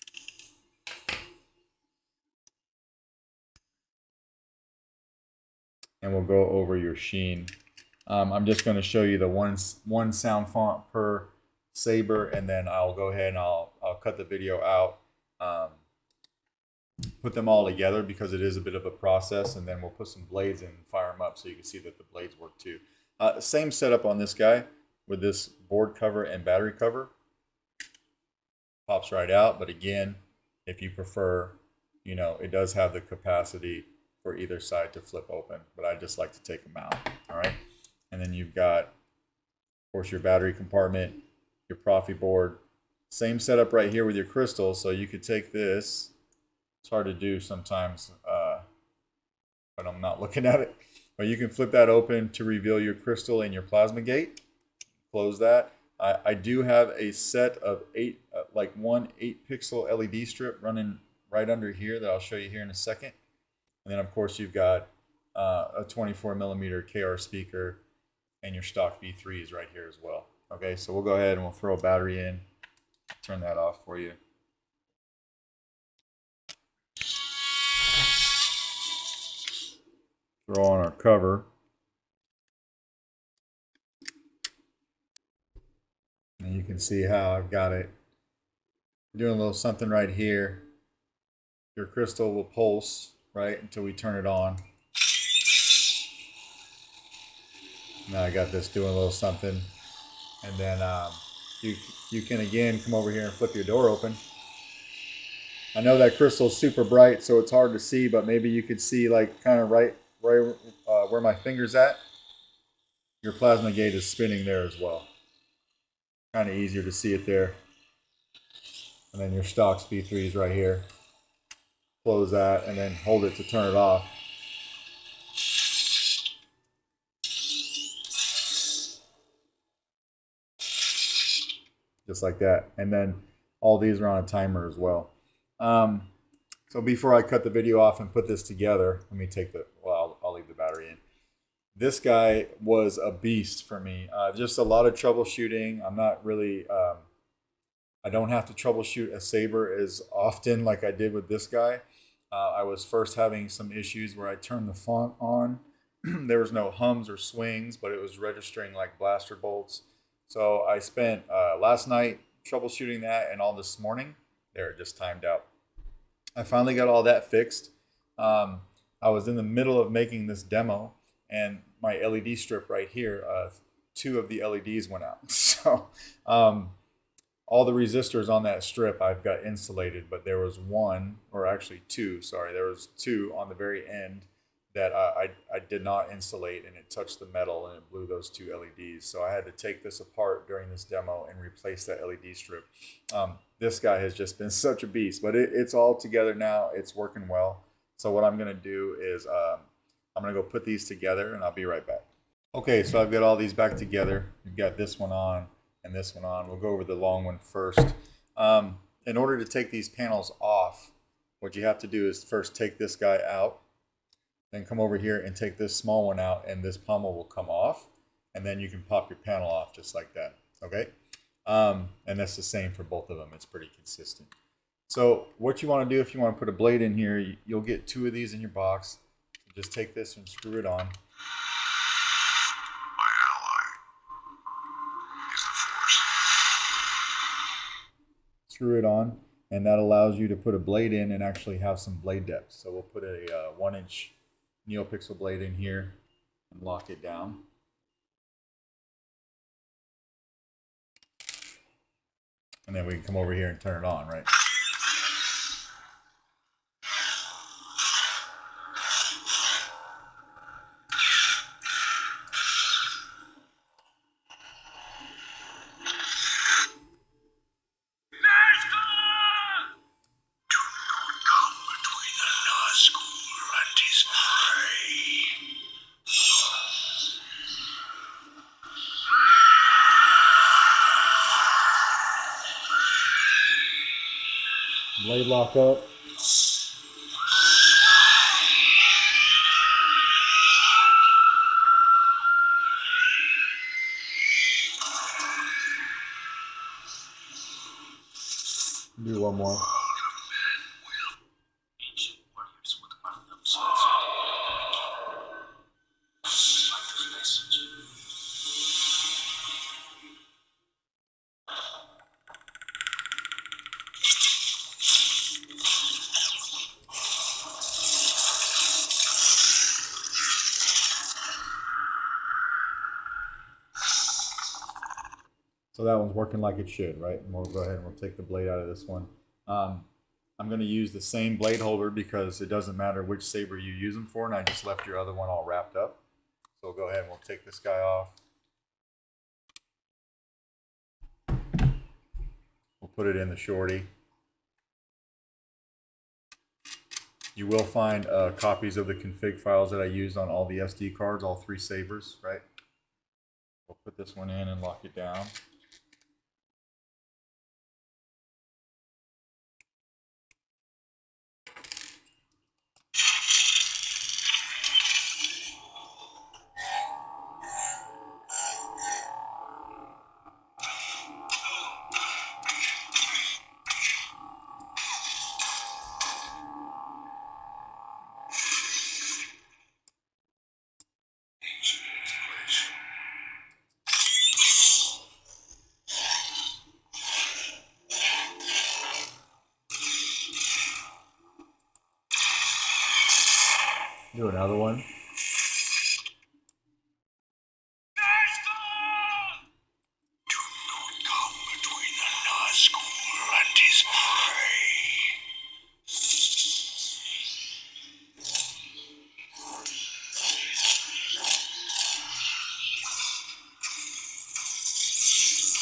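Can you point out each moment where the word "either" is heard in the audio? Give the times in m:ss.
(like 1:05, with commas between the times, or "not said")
0:34.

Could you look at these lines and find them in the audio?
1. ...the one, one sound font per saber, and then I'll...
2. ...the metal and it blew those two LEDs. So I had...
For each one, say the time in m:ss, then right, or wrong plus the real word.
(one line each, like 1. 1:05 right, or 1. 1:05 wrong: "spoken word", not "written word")
1. 0:09 right
2. 3:07 right.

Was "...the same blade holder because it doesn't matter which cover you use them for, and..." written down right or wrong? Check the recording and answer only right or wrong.
wrong.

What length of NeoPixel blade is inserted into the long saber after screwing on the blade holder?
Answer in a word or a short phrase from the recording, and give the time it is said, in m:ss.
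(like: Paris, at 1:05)
1 inch, at 4:03.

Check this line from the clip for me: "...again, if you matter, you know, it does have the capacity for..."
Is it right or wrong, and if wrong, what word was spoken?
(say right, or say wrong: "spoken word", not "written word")
wrong: "prefer", not "matter".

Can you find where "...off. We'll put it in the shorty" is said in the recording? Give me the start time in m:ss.
5:37.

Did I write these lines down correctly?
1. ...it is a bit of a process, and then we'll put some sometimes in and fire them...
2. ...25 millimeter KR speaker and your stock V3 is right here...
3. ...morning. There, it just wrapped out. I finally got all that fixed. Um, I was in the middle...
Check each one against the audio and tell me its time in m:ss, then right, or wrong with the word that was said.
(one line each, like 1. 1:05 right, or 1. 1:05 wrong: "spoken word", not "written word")
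1. 0:18 wrong: "blades", not "sometimes"
2. 1:05 wrong: "24", not "25"
3. 2:43 wrong: "timed", not "wrapped".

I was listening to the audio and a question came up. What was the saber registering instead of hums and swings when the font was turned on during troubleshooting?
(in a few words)
blaster bolts.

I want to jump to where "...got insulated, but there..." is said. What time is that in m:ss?
2:59.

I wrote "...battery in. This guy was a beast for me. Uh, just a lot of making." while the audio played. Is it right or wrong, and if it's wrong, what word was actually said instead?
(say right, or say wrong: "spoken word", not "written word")
wrong: "troubleshooting", not "making".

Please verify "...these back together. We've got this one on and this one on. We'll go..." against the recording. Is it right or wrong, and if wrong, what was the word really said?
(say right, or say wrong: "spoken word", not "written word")
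right.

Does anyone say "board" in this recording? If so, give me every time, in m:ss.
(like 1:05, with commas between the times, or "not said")
0:25, 0:42.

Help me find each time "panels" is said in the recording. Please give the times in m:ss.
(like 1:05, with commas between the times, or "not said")
3:29, 3:39.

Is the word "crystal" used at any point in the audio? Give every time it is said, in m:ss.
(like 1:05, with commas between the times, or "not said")
0:44, 0:52, 1:31, 1:46.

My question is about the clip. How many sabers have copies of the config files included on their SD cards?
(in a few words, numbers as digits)
3.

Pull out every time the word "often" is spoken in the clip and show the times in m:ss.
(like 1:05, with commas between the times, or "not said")
2:30.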